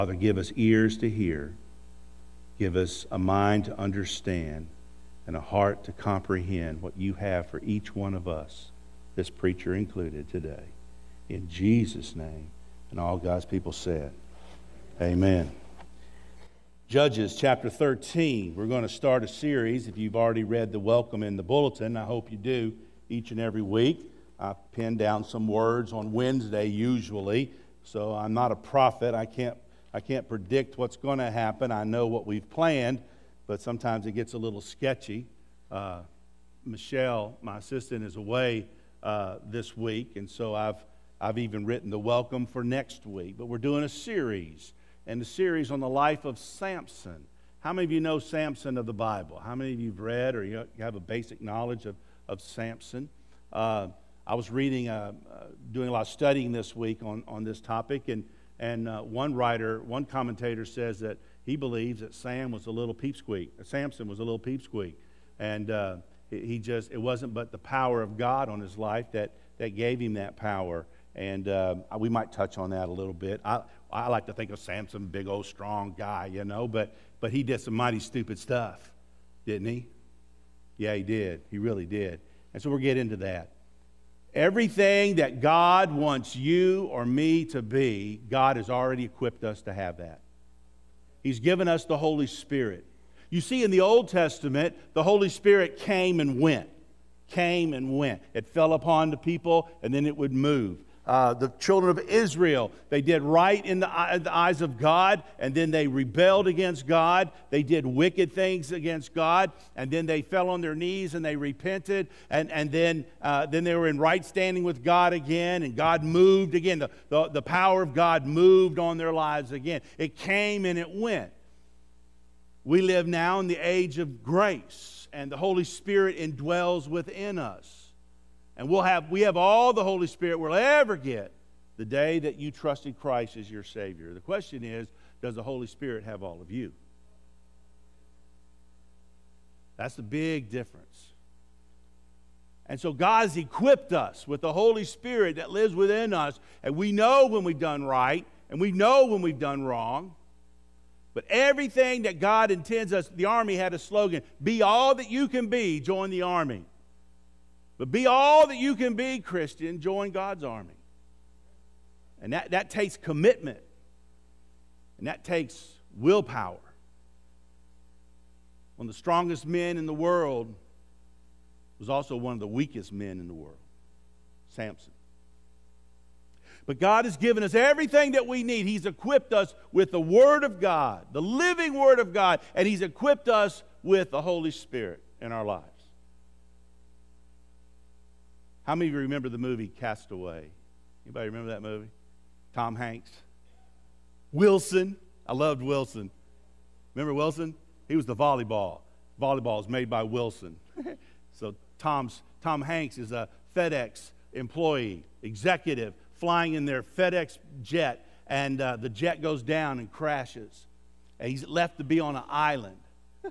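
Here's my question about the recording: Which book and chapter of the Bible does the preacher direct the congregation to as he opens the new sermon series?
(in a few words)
Judges 13.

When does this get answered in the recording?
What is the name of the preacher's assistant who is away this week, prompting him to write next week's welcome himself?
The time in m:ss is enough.
0:36.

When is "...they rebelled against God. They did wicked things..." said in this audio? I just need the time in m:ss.
1:45.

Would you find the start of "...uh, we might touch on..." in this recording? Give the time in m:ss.
1:11.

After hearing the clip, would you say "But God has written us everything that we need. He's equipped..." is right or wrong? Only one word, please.
wrong.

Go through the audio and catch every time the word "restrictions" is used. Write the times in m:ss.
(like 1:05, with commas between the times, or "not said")
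not said.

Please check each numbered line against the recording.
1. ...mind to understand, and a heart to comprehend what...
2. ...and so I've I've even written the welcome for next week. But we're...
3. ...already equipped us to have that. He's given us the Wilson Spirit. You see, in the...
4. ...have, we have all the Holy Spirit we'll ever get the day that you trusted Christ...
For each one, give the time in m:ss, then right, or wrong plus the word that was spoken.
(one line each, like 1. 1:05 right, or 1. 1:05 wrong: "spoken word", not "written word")
1. 0:03 right
2. 0:40 right
3. 1:28 wrong: "Holy", not "Wilson"
4. 2:08 right.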